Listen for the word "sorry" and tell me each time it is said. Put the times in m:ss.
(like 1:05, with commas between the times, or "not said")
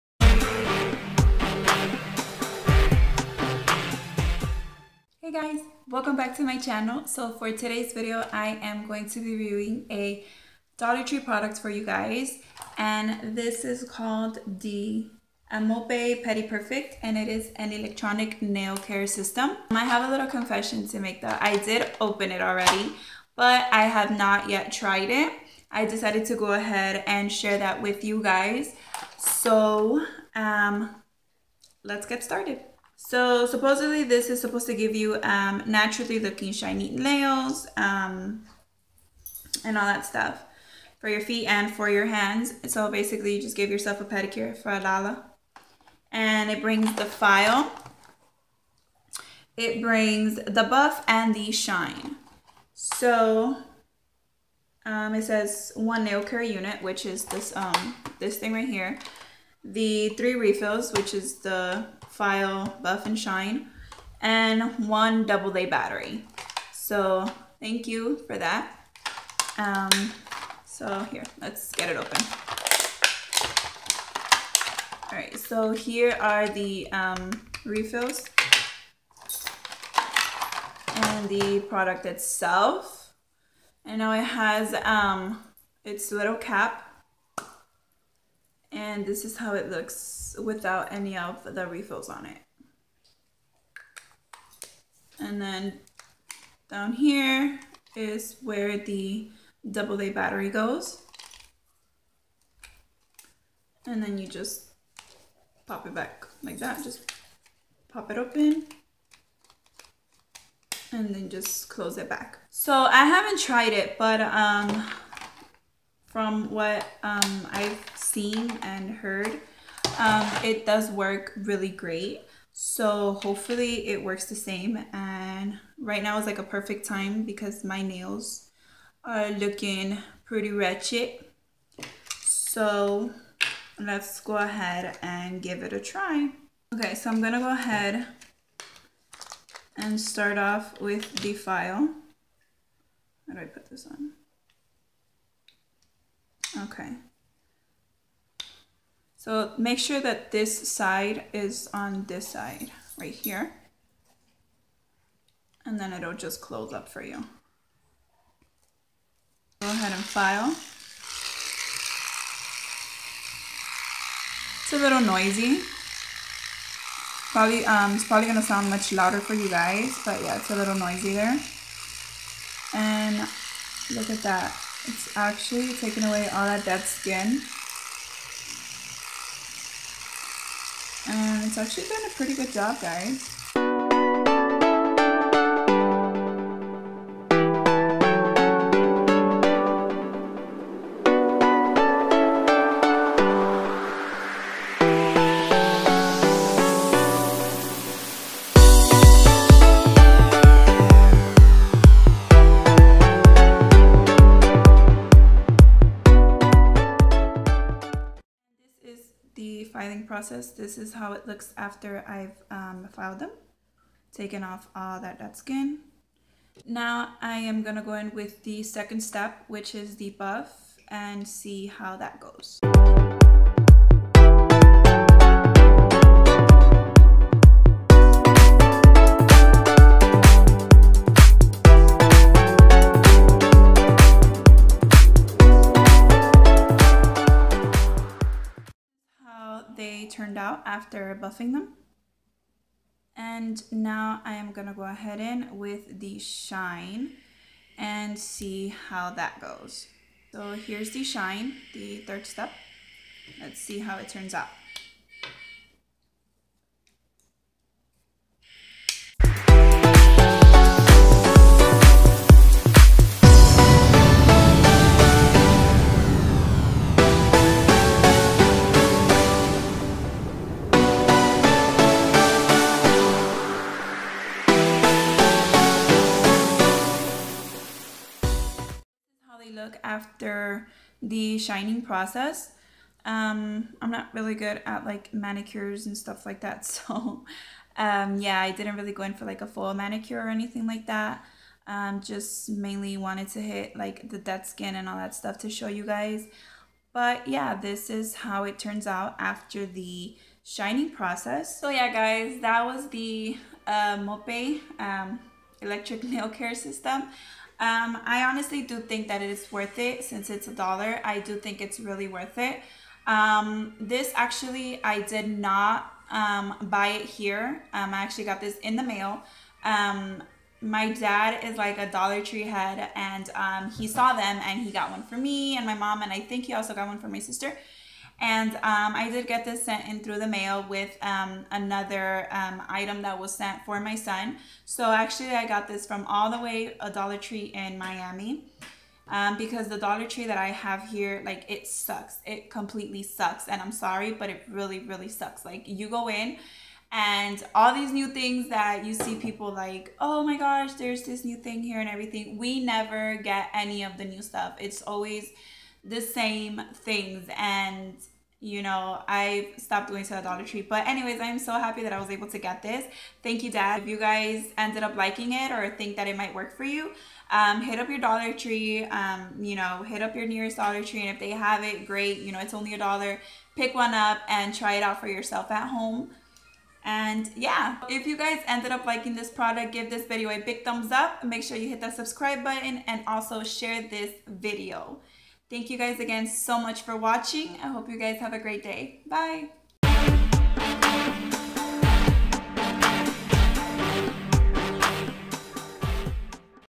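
5:43.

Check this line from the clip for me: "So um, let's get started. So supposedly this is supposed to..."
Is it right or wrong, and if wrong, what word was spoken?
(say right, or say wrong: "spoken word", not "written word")
right.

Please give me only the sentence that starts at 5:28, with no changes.
And um, I did get this sent in through the mail with um, another um, item that was sent for my son.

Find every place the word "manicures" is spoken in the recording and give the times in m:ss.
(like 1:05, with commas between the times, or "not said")
4:45, 4:49.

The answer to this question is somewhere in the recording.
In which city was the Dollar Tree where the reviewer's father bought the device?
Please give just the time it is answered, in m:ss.
5:37.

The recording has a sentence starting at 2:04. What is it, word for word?
And right now is like a perfect time because my nails are looking pretty wretched.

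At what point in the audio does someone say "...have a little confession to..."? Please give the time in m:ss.
0:19.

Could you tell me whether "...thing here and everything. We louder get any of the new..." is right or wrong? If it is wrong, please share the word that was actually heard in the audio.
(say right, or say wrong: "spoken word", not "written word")
wrong: "never", not "louder".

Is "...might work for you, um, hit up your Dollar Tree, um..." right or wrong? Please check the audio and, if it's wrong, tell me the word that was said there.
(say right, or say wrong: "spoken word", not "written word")
right.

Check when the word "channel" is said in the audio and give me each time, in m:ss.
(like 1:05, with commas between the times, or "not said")
0:06.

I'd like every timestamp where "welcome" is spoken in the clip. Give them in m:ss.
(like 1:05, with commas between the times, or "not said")
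0:05.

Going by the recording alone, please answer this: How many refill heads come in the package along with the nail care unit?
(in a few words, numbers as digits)
3.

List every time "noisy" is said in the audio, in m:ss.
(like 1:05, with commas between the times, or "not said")
2:45, 2:50.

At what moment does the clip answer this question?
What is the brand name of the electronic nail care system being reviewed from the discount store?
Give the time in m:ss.
0:15.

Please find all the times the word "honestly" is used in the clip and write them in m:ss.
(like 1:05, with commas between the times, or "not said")
5:08.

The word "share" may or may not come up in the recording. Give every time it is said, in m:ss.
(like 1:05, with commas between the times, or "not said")
0:27, 6:23.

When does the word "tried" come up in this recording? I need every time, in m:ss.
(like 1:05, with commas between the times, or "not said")
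0:24, 1:53.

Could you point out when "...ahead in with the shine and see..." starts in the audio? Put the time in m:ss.
4:04.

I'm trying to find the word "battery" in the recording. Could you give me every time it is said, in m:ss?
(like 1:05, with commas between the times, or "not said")
1:05, 1:40.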